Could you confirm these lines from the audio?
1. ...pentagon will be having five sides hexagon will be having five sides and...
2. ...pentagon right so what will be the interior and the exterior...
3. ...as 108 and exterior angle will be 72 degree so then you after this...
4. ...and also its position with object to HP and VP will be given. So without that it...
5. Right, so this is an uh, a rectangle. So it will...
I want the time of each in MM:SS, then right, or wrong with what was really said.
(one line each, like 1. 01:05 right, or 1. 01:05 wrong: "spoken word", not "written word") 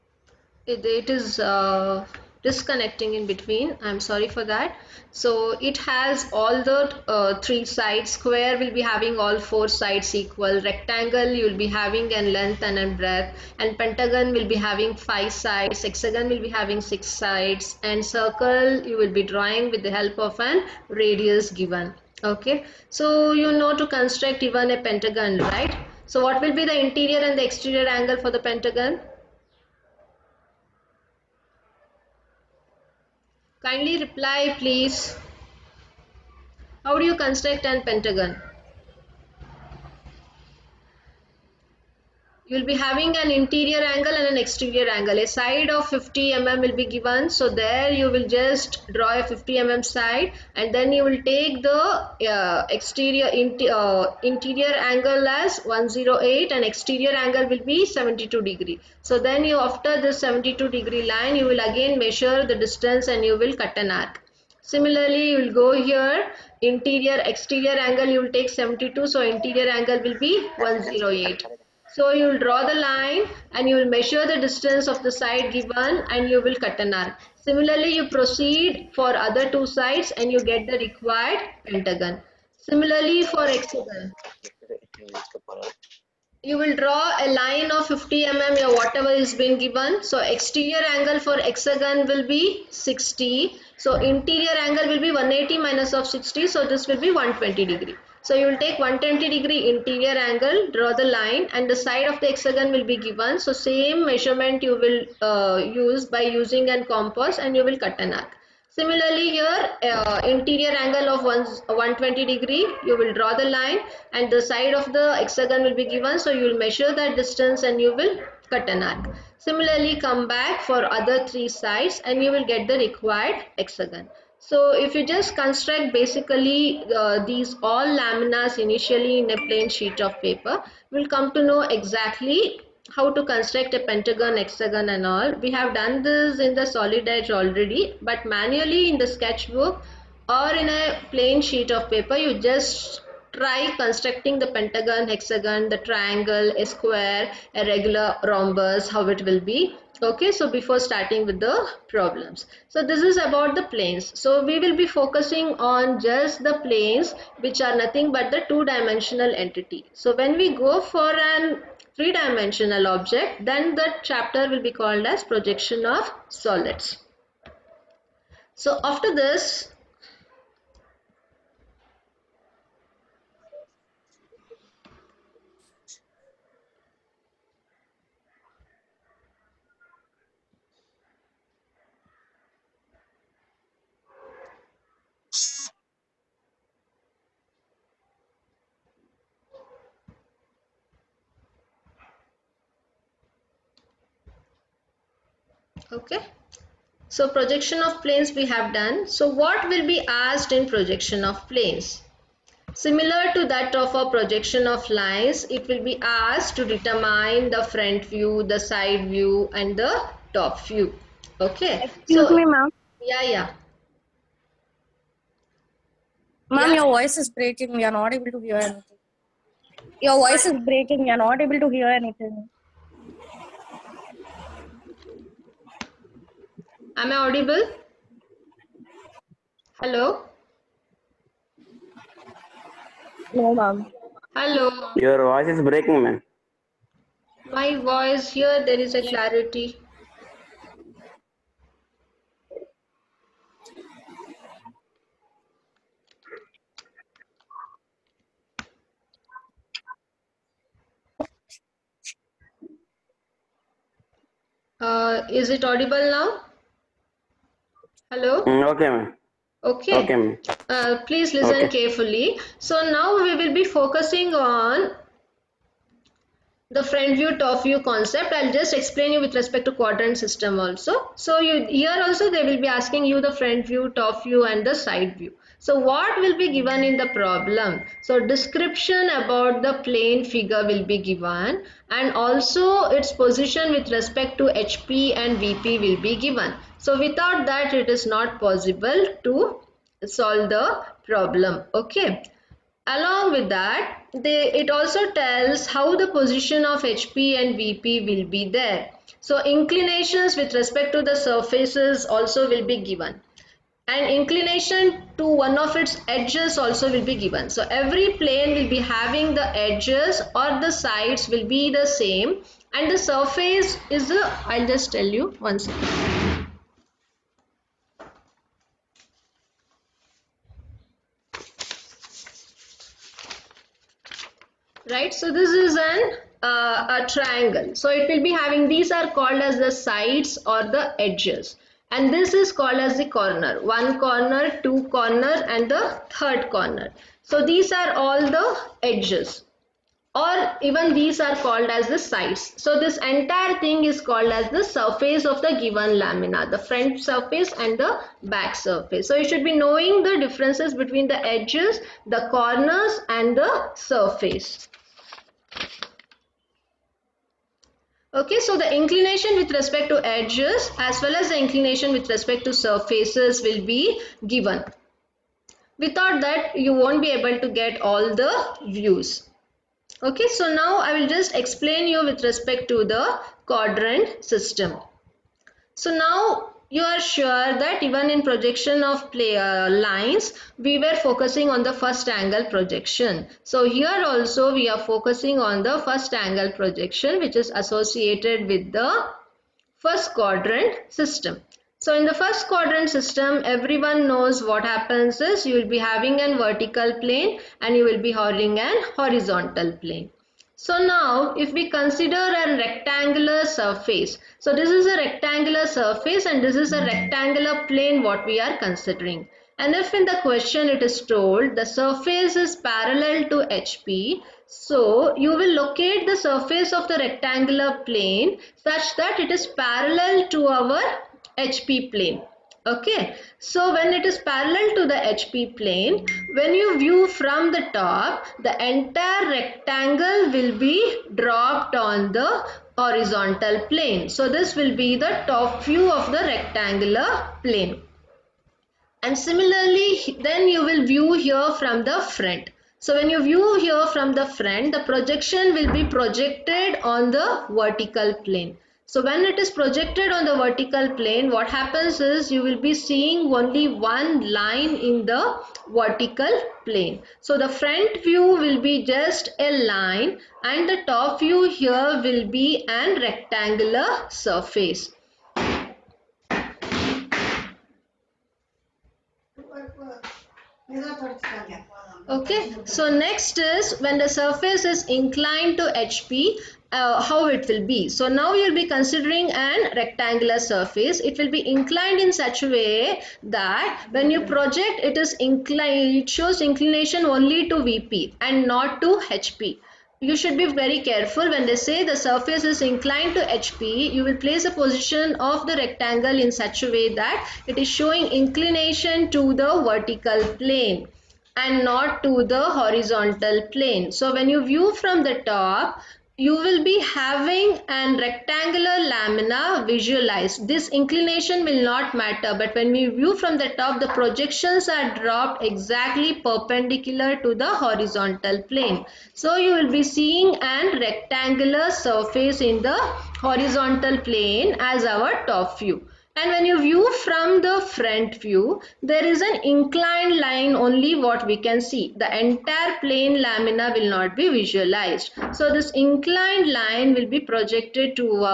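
1. 00:13 wrong: "six", not "five"
2. 00:24 right
3. 00:55 right
4. 04:41 wrong: "respect", not "object"
5. 05:24 wrong: "triangle", not "rectangle".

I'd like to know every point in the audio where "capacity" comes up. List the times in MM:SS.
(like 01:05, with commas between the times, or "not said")
not said.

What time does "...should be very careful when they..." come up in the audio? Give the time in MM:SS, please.
08:10.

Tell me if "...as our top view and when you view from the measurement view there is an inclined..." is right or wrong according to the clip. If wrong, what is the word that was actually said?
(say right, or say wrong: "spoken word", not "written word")
wrong: "front", not "measurement".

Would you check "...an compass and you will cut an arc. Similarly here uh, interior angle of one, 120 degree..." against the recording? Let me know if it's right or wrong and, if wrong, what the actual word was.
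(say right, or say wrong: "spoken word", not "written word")
right.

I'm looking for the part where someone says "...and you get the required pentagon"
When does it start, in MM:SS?
01:20.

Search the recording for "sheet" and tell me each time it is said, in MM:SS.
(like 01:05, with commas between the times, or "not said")
02:09, 02:21.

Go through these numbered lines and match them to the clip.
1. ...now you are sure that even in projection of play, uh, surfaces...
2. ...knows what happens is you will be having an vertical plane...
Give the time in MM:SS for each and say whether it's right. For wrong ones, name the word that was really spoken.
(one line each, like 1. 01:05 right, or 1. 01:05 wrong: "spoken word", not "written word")
1. 06:15 wrong: "lines", not "surfaces"
2. 06:34 right.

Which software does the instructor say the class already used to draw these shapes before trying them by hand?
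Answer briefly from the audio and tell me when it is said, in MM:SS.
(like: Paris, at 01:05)
Solid Edge, at 02:16.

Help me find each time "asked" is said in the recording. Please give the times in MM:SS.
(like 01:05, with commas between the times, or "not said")
03:20, 03:26.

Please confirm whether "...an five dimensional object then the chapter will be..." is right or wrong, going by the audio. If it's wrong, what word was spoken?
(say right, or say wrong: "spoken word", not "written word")
wrong: "three", not "five".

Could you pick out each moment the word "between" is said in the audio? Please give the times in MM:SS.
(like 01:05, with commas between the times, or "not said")
00:03, 05:50.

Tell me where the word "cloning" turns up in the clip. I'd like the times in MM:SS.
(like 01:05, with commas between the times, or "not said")
not said.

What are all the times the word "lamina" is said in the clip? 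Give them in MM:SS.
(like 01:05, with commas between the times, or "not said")
02:07, 05:46, 08:28, 08:53.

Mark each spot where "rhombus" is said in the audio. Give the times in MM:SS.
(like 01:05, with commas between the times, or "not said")
02:28.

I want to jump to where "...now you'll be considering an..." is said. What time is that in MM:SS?
07:58.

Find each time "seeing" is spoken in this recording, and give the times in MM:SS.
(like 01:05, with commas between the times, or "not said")
07:32, 08:39.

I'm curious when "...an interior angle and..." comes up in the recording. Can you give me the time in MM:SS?
00:43.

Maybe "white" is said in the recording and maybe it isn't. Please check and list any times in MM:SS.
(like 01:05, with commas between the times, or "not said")
not said.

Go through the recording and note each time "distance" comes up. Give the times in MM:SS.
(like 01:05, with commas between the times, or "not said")
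01:02, 01:14, 01:57.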